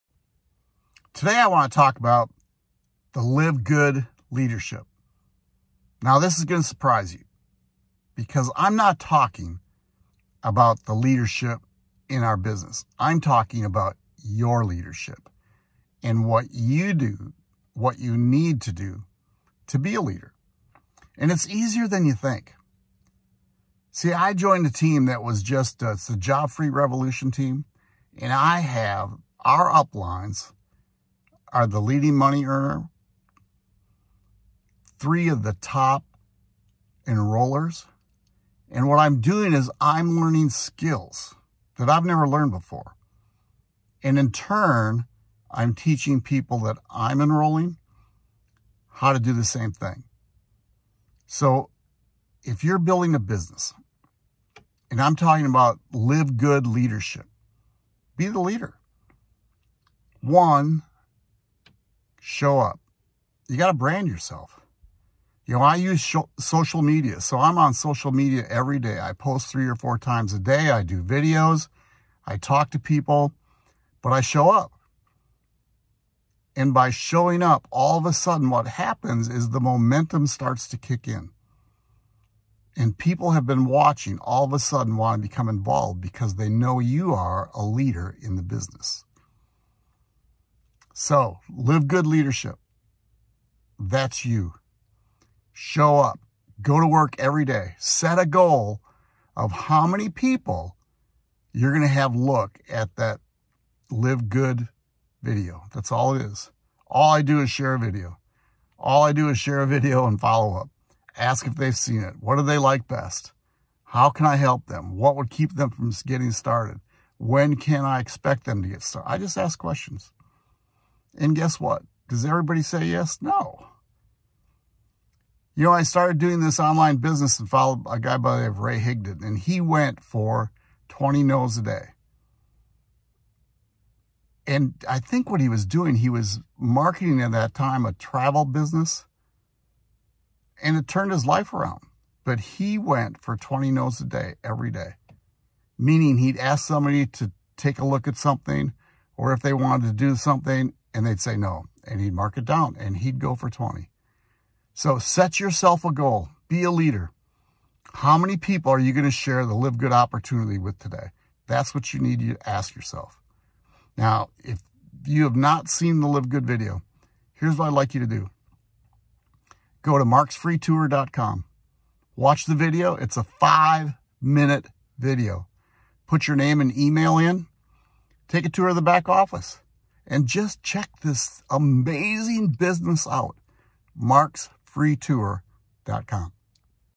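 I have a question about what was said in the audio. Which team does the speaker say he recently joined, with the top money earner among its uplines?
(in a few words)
Job Free Revolution.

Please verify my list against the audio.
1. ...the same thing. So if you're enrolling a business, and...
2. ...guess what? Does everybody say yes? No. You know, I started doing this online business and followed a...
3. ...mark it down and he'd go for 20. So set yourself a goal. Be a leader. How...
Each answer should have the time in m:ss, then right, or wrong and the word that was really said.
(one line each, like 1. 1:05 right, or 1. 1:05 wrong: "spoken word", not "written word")
1. 0:49 wrong: "building", not "enrolling"
2. 2:01 right
3. 2:32 right.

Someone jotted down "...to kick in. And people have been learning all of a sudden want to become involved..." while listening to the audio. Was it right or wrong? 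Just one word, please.
wrong.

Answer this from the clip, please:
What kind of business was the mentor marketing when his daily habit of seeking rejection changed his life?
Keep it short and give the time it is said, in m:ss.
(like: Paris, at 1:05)
Travel business, at 2:17.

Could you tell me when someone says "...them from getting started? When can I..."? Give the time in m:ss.
1:55.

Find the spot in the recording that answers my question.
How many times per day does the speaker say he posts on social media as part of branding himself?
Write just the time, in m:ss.
1:09.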